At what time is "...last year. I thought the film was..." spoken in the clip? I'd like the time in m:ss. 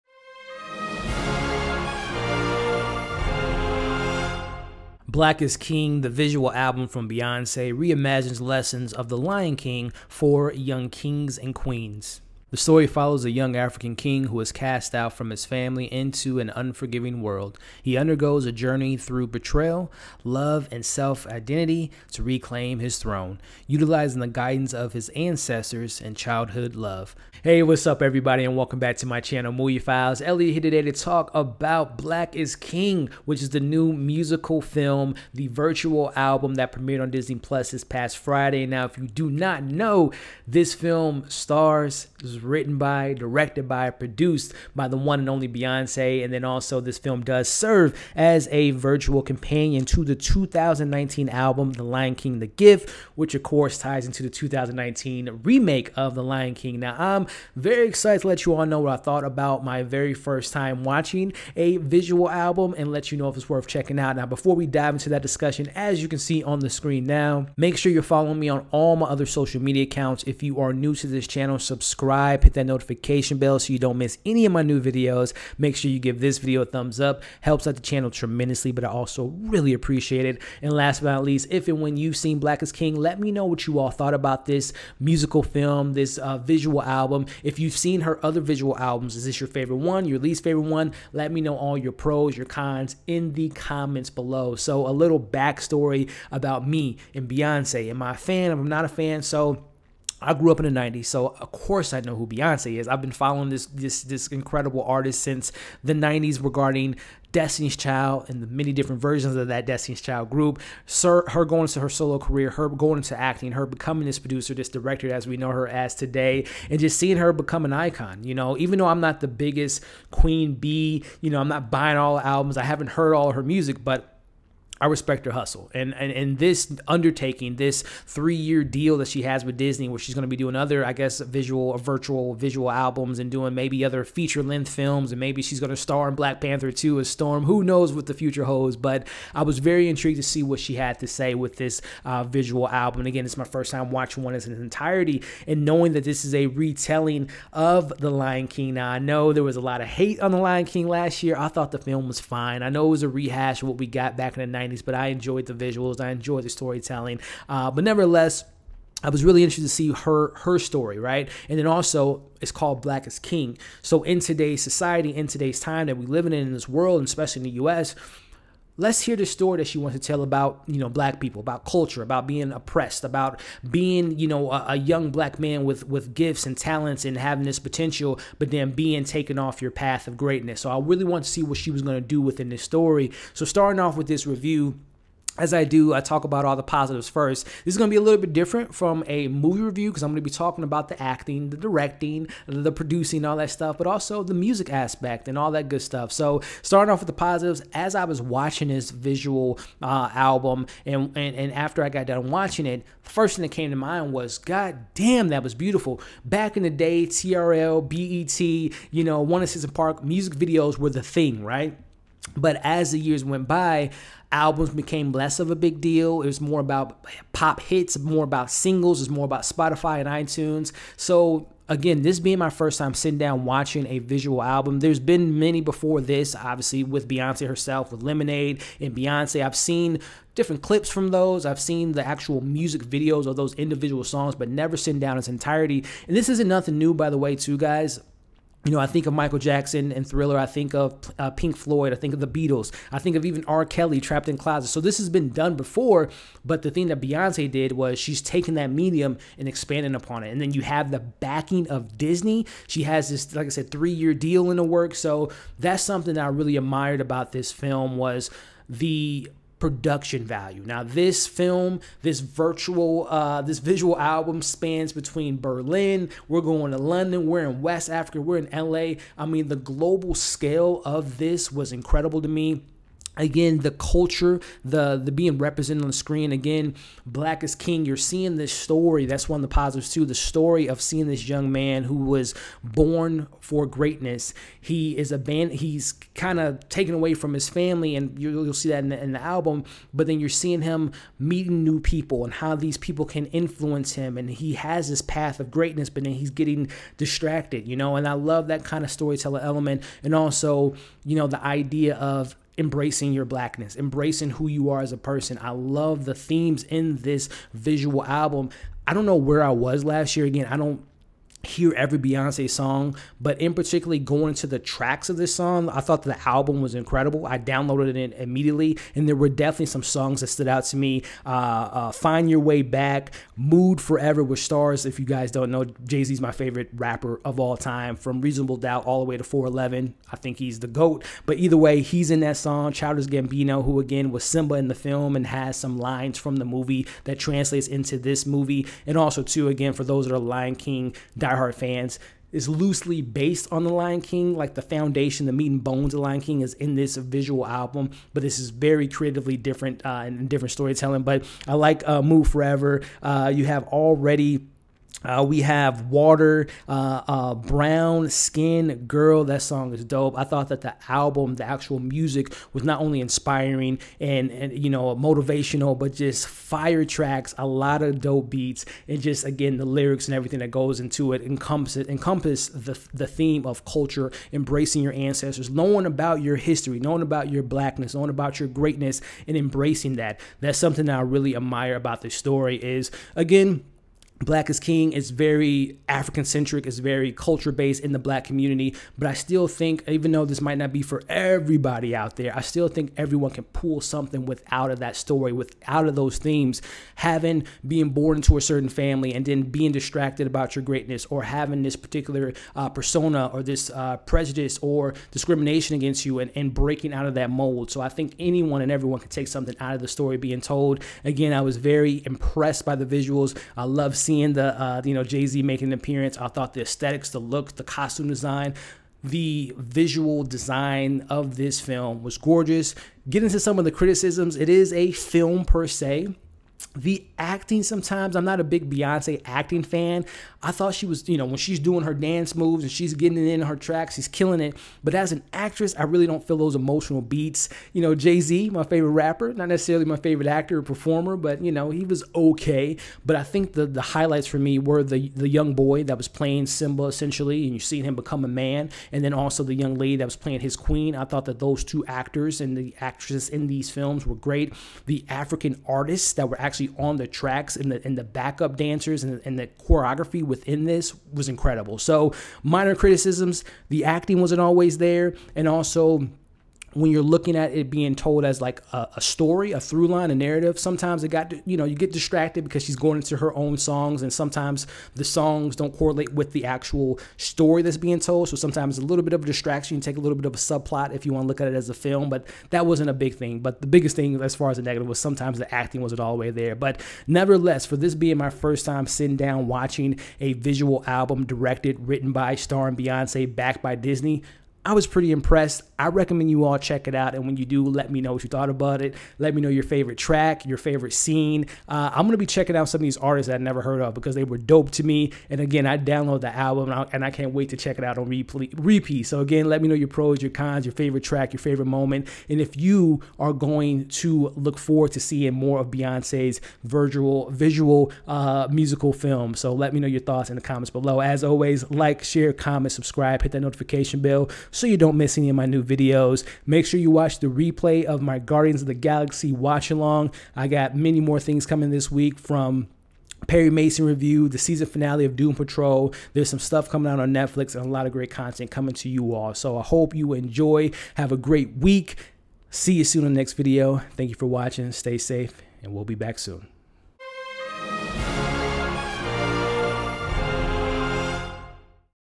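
2:30.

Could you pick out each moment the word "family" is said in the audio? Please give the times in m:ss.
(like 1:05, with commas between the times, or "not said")
0:15, 4:47, 6:38.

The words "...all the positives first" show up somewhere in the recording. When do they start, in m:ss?
3:06.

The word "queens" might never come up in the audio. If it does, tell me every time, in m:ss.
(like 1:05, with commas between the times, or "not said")
0:11, 2:00, 7:30.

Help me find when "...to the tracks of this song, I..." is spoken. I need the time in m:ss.
5:14.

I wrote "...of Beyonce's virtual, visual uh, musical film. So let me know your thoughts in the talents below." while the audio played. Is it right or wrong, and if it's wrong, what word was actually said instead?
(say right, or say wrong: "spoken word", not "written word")
wrong: "comments", not "talents".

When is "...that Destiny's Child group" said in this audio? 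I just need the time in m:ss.
1:49.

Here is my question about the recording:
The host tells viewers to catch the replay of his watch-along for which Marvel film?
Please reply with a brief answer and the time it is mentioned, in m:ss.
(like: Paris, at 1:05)
Guardians of the Galaxy, at 8:48.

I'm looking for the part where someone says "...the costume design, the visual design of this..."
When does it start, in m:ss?
6:57.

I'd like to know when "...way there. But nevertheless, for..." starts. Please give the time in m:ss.
8:06.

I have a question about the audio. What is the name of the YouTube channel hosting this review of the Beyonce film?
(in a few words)
Movie Files.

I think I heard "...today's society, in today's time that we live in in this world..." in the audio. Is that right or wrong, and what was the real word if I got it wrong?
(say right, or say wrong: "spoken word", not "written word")
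right.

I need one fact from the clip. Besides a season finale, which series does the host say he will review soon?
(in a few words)
Perry Mason.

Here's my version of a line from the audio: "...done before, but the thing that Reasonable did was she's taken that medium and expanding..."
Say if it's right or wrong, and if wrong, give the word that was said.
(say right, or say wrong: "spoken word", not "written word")
wrong: "Beyonce", not "Reasonable".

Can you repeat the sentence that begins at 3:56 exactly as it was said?
And this isn't nothing new, by the way, too, guys you know, I think of Michael Jackson and Thriller.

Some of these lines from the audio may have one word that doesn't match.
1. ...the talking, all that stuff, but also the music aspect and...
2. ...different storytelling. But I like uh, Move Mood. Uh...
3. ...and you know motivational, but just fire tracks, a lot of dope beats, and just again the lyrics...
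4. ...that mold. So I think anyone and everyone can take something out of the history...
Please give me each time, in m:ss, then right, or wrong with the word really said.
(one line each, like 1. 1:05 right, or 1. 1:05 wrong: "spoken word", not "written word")
1. 3:12 wrong: "producing", not "talking"
2. 5:50 wrong: "Forever", not "Mood"
3. 6:04 right
4. 6:47 wrong: "story", not "history".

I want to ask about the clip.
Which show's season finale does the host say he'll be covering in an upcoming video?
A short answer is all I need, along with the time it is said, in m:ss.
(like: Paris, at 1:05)
Doom Patrol, at 8:55.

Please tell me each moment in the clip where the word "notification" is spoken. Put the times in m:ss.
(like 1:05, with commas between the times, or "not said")
1:12, 8:43.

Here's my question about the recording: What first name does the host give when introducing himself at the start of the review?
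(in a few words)
Elliot.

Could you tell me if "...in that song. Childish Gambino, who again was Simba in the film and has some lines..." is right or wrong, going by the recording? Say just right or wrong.
right.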